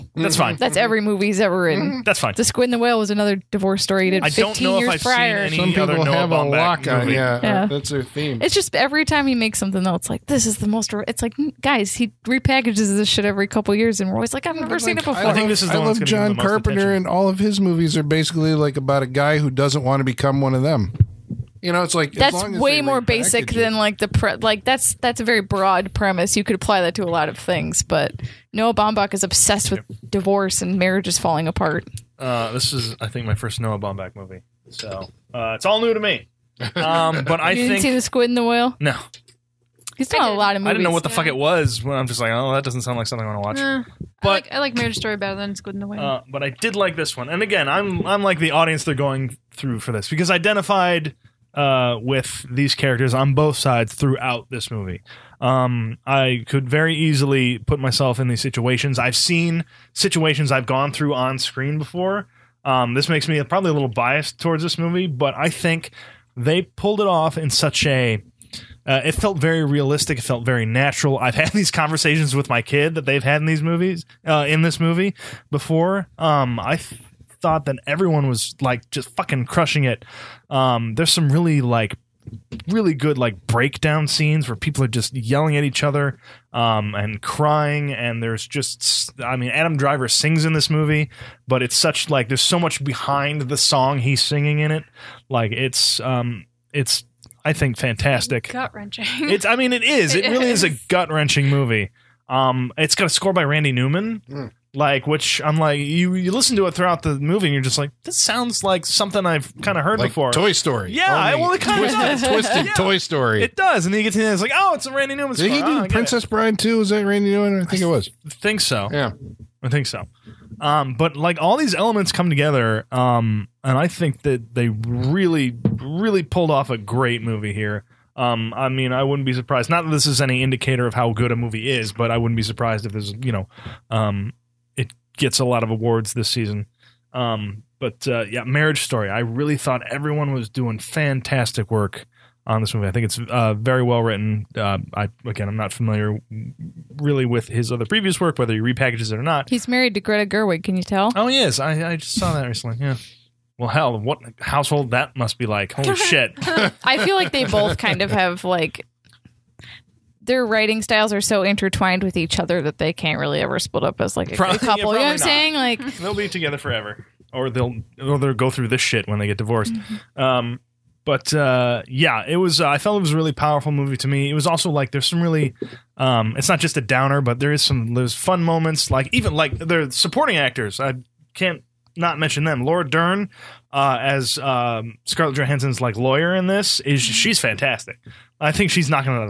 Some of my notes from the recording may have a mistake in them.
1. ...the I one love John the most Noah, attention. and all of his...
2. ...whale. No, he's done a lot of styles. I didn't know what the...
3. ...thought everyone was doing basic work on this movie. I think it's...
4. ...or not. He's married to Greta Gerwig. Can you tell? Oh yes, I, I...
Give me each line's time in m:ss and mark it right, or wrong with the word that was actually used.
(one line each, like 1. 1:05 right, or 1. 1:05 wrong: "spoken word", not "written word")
1. 0:15 wrong: "Carpenter", not "Noah"
2. 0:38 wrong: "movies", not "styles"
3. 2:19 wrong: "fantastic", not "basic"
4. 2:29 right.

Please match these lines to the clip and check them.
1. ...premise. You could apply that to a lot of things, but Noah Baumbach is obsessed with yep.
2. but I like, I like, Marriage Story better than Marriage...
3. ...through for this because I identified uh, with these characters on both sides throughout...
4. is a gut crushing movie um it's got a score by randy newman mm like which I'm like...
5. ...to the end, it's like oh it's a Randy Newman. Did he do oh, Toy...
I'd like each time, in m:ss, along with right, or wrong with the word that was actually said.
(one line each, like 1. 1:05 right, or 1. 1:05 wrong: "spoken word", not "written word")
1. 0:25 right
2. 0:44 wrong: "Squid", not "Marriage"
3. 0:49 right
4. 1:40 wrong: "wrenching", not "crushing"
5. 1:54 wrong: "Princess", not "Toy".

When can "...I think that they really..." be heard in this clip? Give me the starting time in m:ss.
2:03.